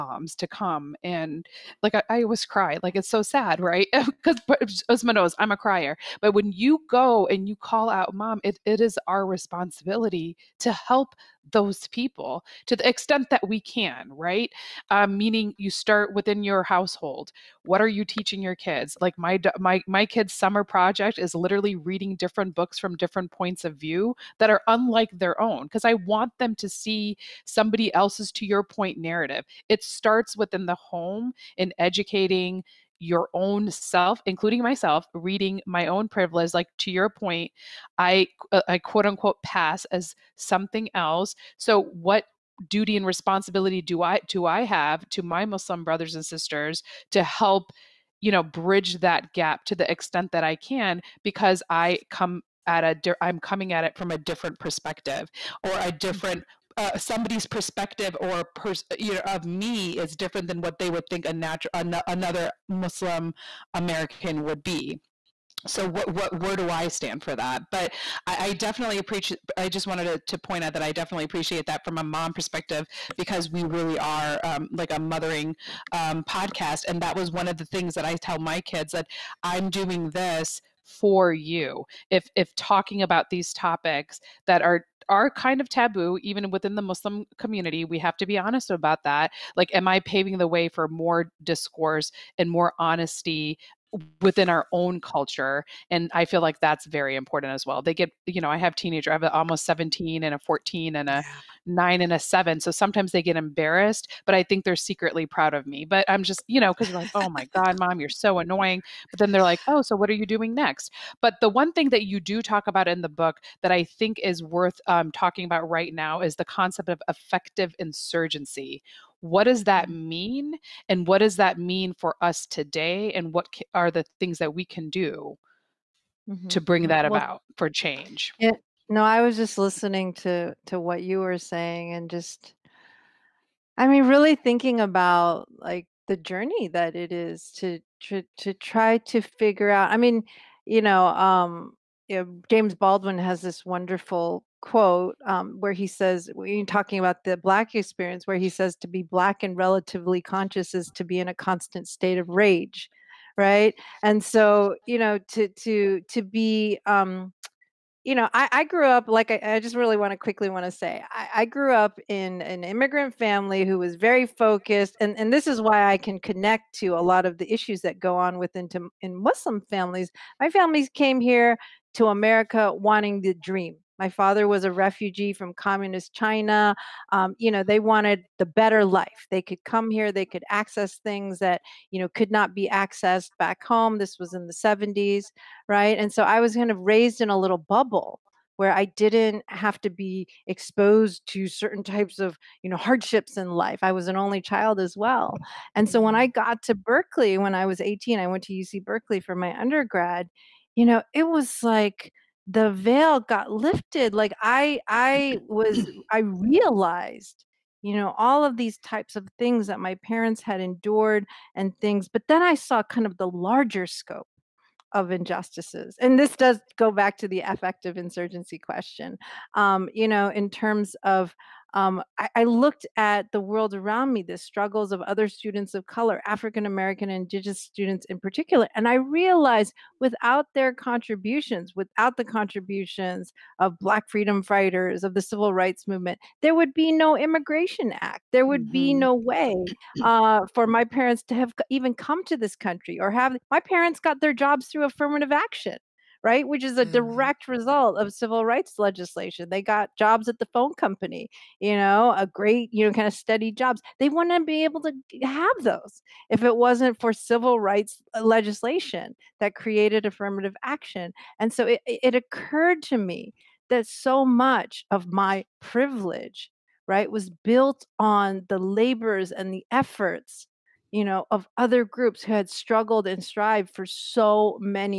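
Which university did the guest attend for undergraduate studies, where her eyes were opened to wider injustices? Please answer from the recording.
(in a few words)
UC Berkeley.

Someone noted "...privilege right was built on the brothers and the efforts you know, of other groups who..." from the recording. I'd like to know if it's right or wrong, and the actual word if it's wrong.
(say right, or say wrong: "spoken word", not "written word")
wrong: "labors", not "brothers".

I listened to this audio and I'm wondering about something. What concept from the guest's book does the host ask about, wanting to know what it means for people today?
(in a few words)
affective insurgency.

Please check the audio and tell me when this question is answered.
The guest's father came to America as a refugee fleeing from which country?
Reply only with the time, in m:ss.
2:55.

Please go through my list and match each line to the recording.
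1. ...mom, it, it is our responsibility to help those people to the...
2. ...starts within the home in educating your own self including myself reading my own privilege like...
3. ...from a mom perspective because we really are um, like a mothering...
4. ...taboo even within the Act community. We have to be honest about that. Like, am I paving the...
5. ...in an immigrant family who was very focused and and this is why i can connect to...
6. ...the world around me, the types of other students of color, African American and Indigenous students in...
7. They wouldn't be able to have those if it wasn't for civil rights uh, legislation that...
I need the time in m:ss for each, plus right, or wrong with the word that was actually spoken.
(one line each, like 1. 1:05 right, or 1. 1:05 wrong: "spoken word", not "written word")
1. 0:08 right
2. 0:29 right
3. 1:11 right
4. 1:25 wrong: "Muslim", not "Act"
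5. 2:42 right
6. 3:43 wrong: "struggles", not "types"
7. 4:13 right.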